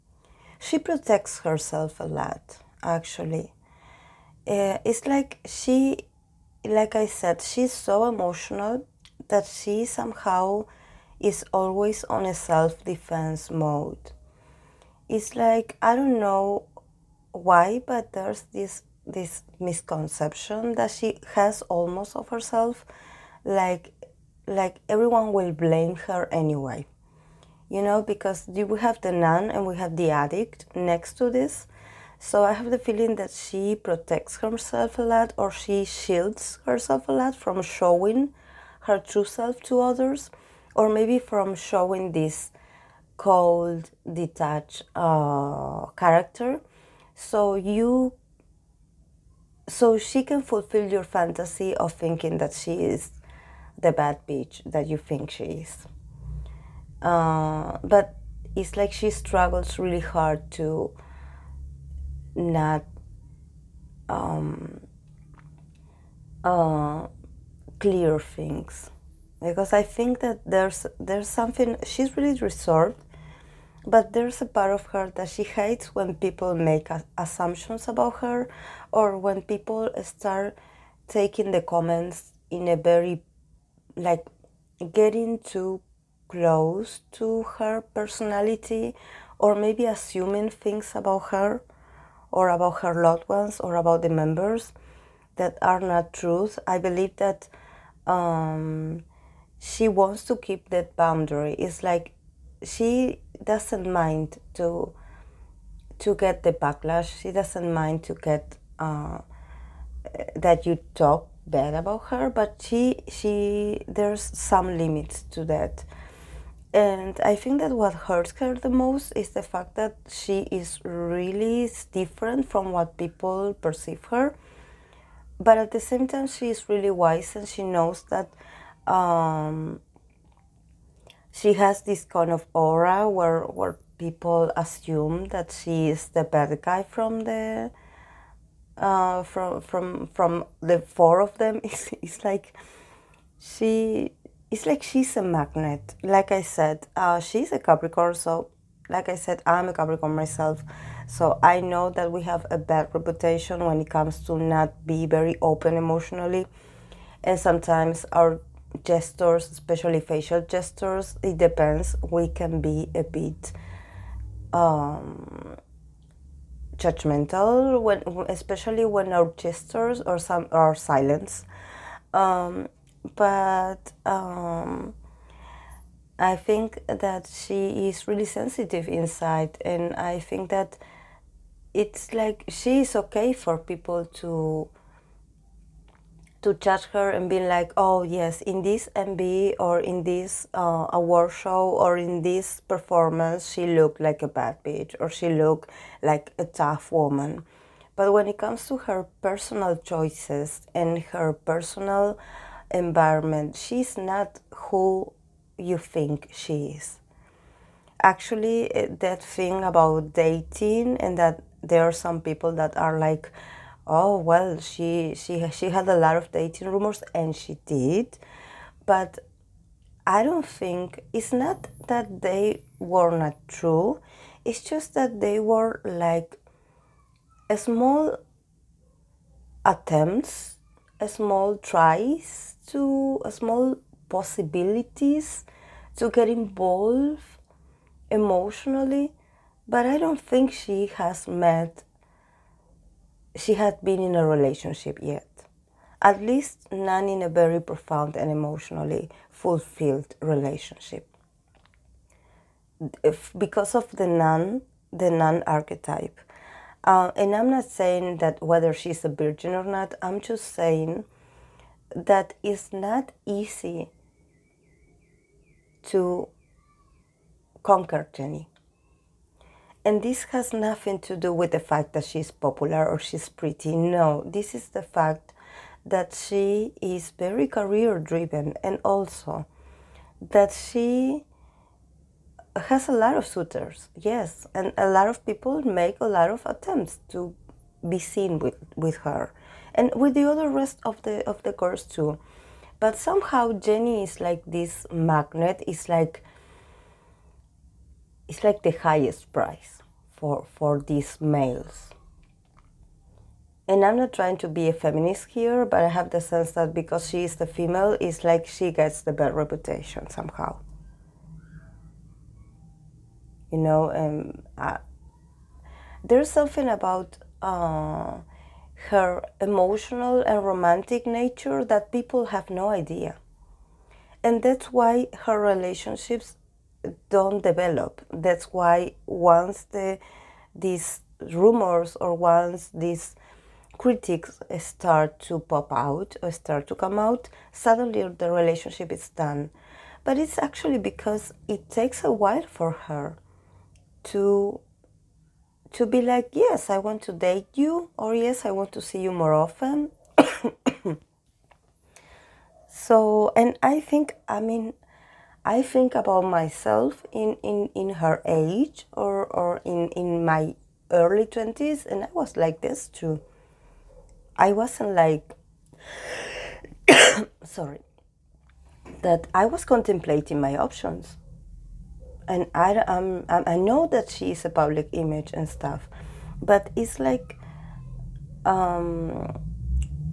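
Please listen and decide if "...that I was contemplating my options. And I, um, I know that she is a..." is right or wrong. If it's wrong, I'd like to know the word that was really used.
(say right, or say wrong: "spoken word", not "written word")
right.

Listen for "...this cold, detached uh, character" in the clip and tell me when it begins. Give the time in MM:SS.
00:42.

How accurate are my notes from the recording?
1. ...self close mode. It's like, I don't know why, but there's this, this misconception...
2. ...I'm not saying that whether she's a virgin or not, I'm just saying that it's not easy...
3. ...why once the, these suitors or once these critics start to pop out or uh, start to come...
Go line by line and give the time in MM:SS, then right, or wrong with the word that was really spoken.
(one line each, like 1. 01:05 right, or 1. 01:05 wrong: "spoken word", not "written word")
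1. 00:12 wrong: "defense", not "close"
2. 04:17 right
3. 05:28 wrong: "rumors", not "suitors".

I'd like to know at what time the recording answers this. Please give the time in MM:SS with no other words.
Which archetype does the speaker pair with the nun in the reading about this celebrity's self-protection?
00:29.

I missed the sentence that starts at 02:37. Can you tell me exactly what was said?
And sometimes our gestures, especially facial gestures, it depends.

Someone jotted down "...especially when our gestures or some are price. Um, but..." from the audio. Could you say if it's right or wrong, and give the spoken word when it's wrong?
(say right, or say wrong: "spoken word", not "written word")
wrong: "silence", not "price".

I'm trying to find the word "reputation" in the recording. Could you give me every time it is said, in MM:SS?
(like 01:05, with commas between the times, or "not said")
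02:32, 05:09.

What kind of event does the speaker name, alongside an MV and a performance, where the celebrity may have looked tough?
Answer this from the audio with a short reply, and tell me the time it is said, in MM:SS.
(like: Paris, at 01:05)
Award show, at 03:10.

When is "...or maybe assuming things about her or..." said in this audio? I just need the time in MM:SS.
01:29.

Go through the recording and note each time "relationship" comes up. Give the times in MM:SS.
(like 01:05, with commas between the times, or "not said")
04:04, 04:10, 05:25, 05:38.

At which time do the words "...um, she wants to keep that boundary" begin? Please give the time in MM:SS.
01:38.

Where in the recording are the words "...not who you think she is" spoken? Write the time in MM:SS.
03:23.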